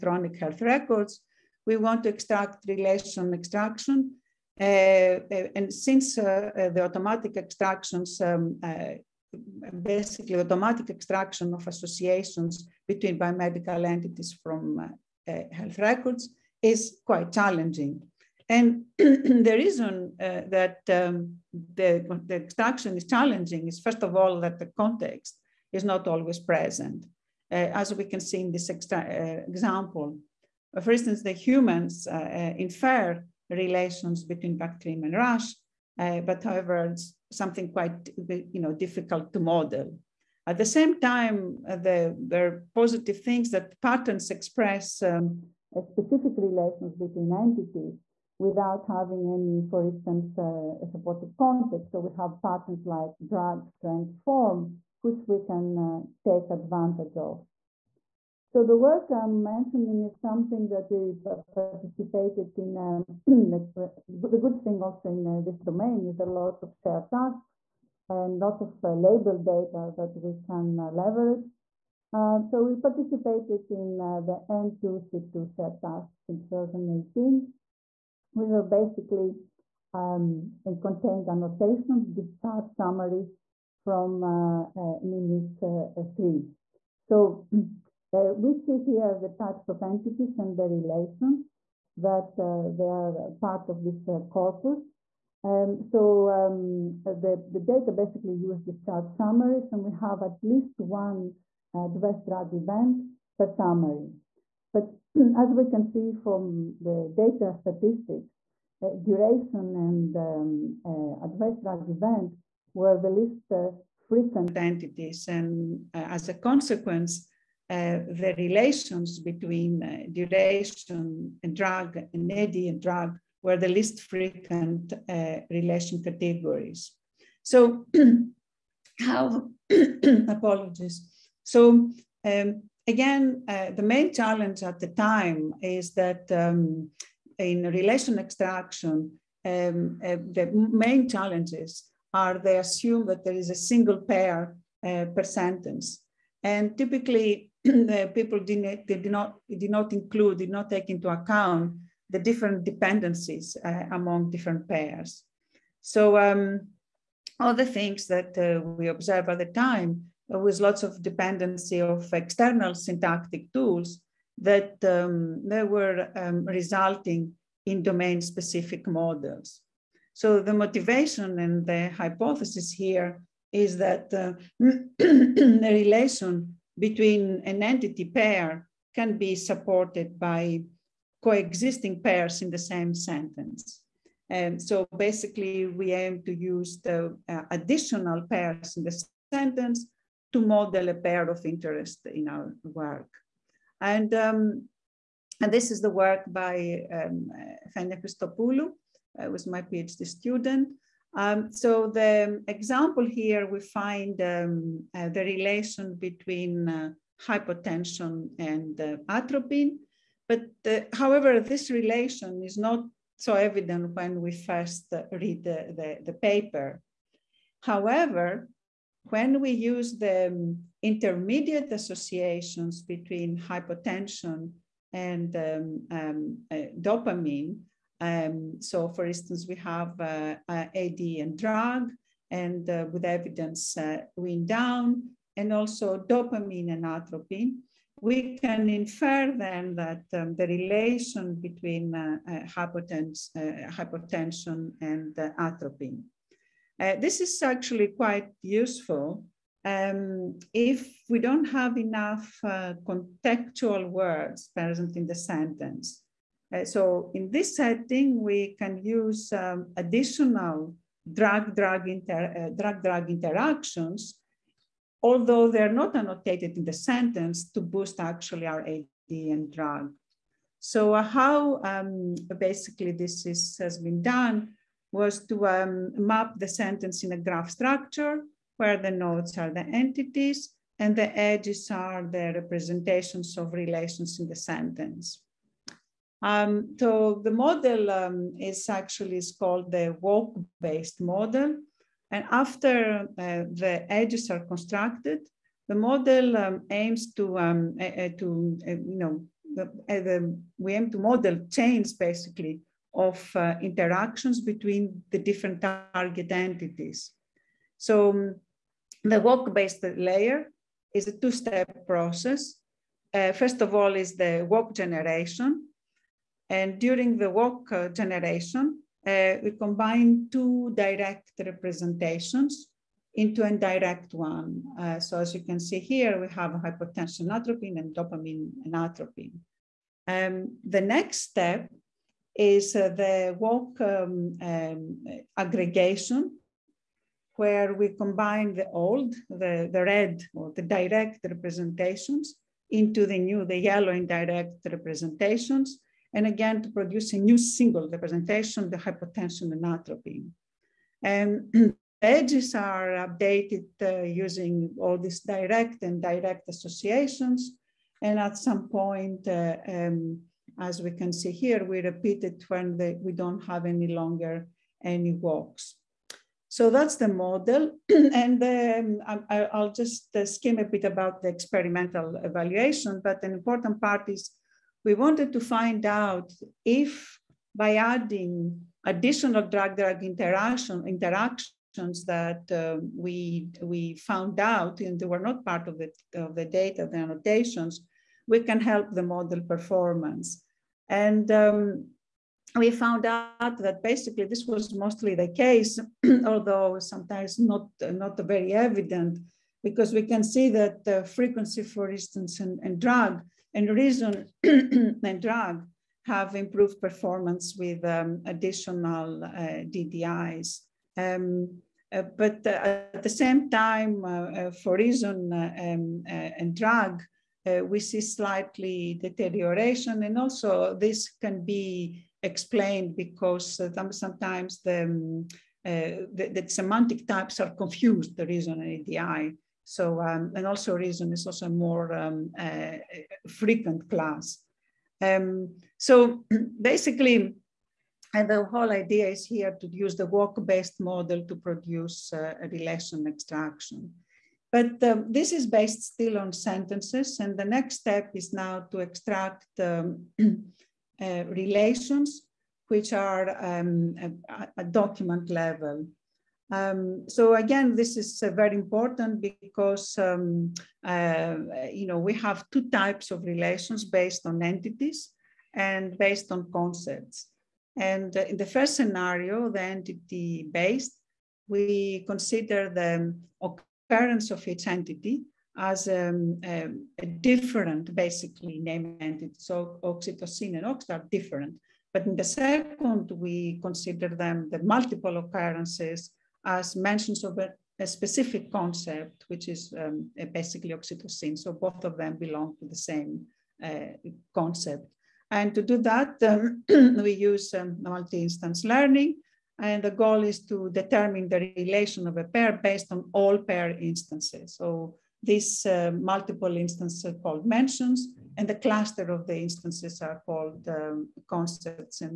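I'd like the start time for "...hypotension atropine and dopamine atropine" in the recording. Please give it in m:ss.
5:26.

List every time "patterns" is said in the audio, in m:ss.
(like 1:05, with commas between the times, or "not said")
0:43, 0:52.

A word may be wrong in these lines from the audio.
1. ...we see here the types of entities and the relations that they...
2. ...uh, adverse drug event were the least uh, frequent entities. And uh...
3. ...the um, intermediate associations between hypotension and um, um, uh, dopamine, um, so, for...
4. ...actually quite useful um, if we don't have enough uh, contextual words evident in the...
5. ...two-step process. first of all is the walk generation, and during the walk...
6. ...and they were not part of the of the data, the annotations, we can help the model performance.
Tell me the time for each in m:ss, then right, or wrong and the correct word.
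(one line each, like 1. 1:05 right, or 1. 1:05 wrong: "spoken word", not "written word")
1. 1:28 right
2. 1:50 right
3. 3:39 right
4. 4:07 wrong: "present", not "evident"
5. 5:11 right
6. 6:24 right.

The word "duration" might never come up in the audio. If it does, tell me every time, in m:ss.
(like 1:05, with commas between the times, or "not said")
1:49, 2:00.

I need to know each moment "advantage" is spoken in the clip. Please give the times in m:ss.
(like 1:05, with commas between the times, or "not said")
0:56.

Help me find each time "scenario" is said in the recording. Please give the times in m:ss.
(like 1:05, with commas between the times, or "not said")
7:48.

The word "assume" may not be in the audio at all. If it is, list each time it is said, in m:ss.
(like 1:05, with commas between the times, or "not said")
2:22.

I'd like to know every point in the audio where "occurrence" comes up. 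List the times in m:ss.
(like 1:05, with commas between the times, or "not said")
7:53, 8:05.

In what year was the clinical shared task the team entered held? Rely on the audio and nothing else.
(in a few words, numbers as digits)
2018.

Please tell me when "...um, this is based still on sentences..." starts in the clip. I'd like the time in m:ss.
7:24.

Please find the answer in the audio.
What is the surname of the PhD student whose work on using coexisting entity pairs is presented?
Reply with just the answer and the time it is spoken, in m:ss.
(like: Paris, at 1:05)
Christopoulou, at 3:17.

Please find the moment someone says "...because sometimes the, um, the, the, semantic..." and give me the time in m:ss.
7:02.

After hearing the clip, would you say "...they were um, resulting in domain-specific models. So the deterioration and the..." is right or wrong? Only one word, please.
wrong.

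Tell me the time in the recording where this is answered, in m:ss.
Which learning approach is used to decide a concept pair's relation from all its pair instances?
8:17.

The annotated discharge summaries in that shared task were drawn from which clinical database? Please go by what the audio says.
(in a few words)
MIMIC 3.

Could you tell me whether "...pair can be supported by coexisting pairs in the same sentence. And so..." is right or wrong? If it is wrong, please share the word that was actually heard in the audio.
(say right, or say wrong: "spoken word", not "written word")
right.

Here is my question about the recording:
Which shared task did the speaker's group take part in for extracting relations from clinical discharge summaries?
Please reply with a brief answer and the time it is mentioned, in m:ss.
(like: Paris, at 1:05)
N2C2, at 1:14.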